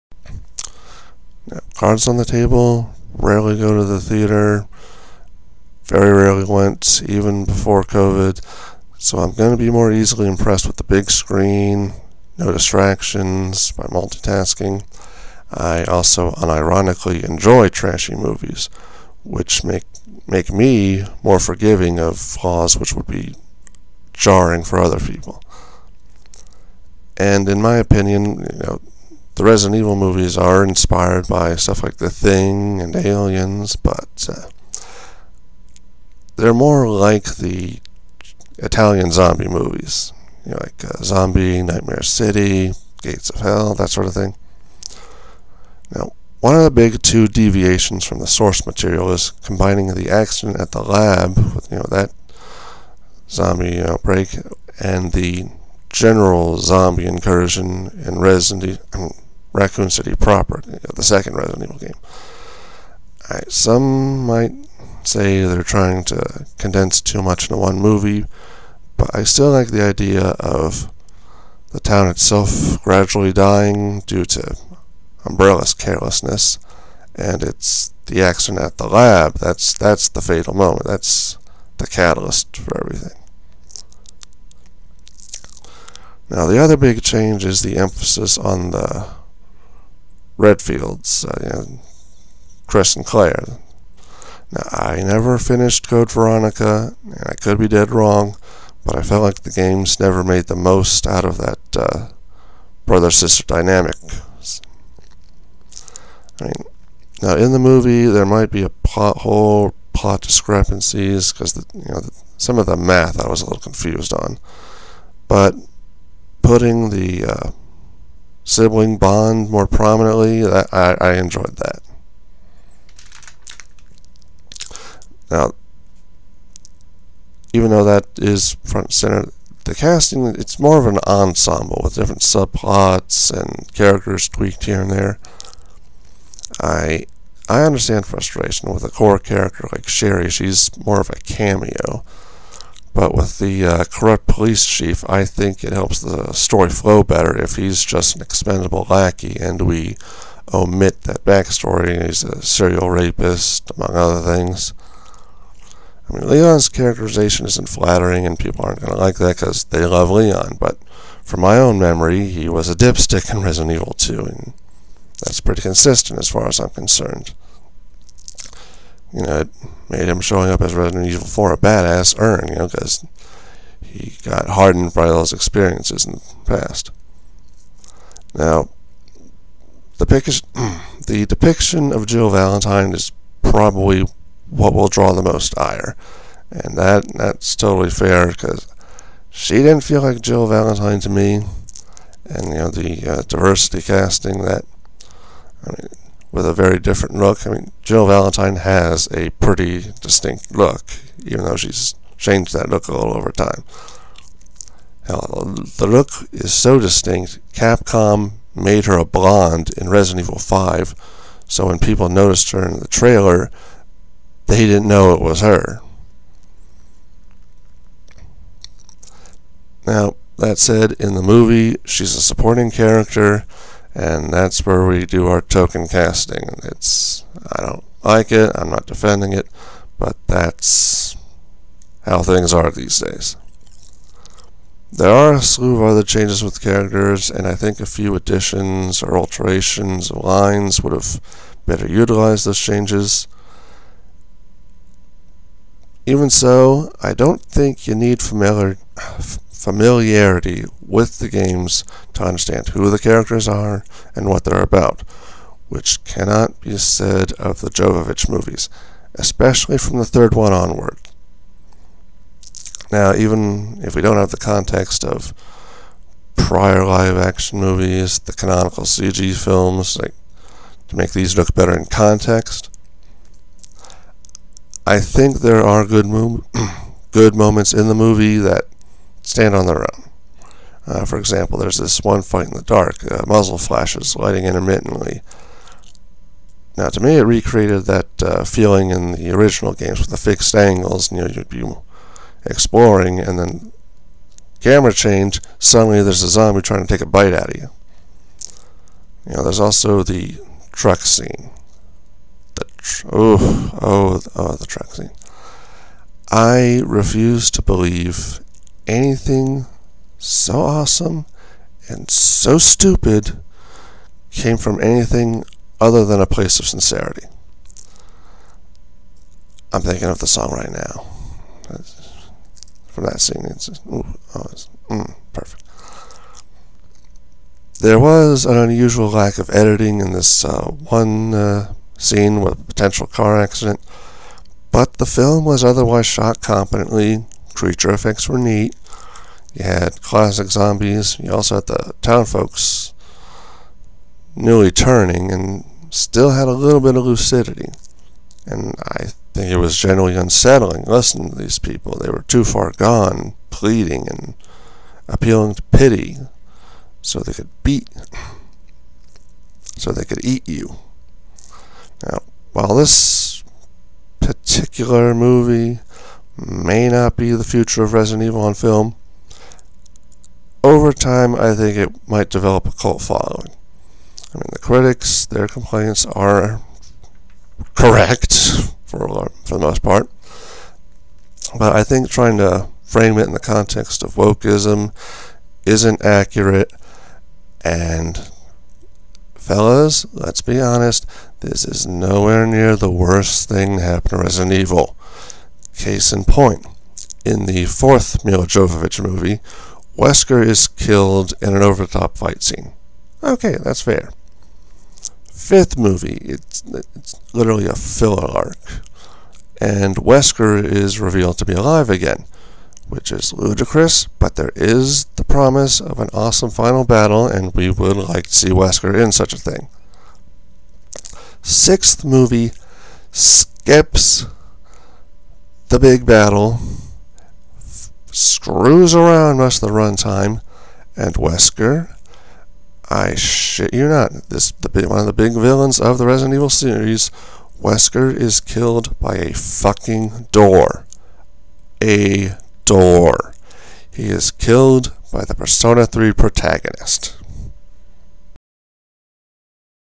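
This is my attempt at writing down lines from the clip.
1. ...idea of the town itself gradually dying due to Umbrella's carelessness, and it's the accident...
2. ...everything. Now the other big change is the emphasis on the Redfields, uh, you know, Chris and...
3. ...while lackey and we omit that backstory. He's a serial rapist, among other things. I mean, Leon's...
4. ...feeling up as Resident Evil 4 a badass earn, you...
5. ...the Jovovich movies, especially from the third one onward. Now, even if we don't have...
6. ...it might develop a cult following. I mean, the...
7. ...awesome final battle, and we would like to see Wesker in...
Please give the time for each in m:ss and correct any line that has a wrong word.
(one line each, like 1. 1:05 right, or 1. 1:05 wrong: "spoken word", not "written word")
1. 1:09 right
2. 1:22 right
3. 2:28 wrong: "expendable", not "while"
4. 2:50 wrong: "showing", not "feeling"
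5. 4:17 right
6. 6:11 right
7. 6:56 right.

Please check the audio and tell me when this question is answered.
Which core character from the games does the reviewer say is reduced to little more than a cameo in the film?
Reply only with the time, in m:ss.
2:19.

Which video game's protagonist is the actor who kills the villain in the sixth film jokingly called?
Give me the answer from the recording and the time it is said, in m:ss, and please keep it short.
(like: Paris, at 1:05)
Persona 3, at 7:25.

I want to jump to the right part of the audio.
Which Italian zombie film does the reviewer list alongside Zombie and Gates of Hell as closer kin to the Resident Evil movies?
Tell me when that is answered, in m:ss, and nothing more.
0:41.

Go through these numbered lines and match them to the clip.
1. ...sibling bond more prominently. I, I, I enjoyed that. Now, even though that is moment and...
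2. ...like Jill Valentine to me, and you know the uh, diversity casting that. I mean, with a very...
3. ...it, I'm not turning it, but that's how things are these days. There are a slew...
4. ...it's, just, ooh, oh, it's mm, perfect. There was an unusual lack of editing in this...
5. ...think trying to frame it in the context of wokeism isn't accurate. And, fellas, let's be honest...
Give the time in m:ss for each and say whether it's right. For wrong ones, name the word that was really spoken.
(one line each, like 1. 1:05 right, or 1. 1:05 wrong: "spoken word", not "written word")
1. 1:58 wrong: "front", not "moment"
2. 3:10 right
3. 3:48 wrong: "defending", not "turning"
4. 5:23 right
5. 6:21 right.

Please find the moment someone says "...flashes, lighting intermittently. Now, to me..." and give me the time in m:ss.
4:43.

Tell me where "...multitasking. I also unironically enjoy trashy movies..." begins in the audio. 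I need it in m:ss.
0:13.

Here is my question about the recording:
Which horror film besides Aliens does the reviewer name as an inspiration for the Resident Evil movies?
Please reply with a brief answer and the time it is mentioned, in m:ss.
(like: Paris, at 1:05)
The Thing, at 0:31.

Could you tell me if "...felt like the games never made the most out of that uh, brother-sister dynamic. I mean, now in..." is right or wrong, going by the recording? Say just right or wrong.
right.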